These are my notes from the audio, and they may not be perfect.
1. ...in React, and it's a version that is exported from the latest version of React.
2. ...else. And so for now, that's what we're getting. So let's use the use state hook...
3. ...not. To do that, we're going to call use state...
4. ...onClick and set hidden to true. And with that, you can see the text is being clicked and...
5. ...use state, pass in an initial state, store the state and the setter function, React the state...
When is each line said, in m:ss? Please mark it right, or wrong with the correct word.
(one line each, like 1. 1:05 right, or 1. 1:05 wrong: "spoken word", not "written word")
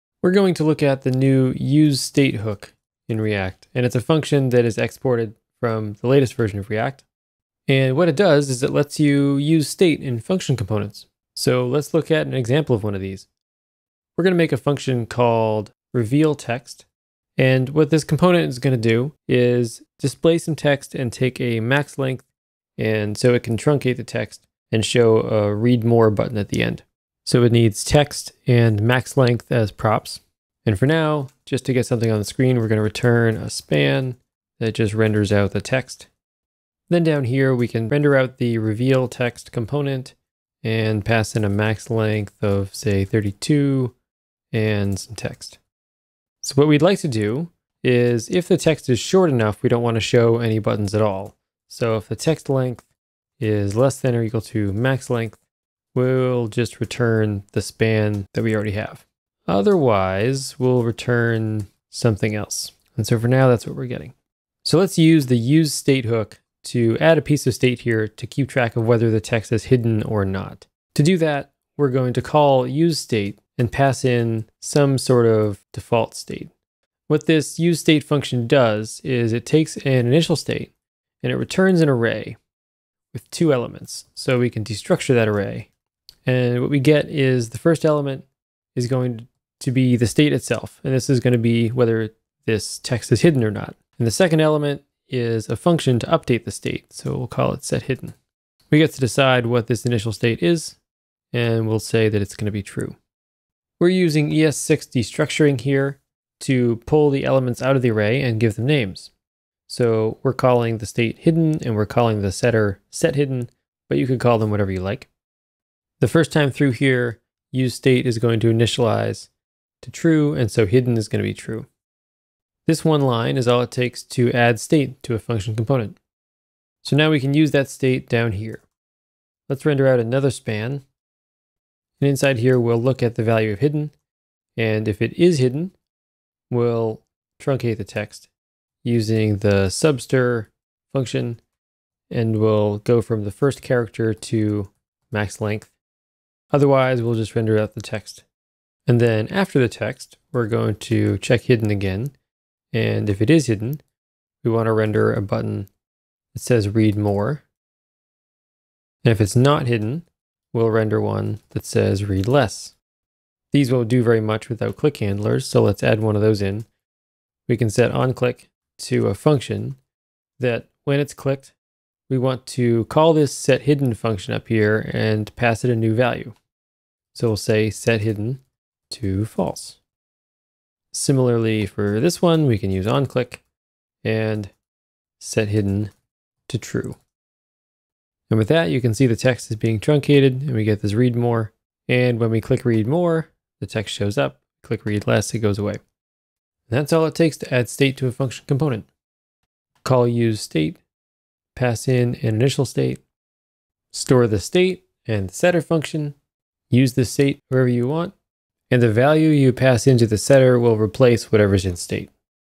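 1. 0:03 wrong: "function", not "version"
2. 1:02 right
3. 1:10 right
4. 3:02 wrong: "truncated", not "clicked"
5. 3:20 wrong: "Use", not "React".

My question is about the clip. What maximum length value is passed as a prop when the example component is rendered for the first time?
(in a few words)
32.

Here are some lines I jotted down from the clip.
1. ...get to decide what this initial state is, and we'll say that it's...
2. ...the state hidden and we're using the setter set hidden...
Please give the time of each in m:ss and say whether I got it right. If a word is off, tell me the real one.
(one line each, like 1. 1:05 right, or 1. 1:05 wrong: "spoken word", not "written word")
1. 1:38 right
2. 1:50 wrong: "calling", not "using".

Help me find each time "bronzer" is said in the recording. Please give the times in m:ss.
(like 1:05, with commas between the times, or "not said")
not said.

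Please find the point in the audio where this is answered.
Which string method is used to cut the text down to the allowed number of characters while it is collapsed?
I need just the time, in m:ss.
2:19.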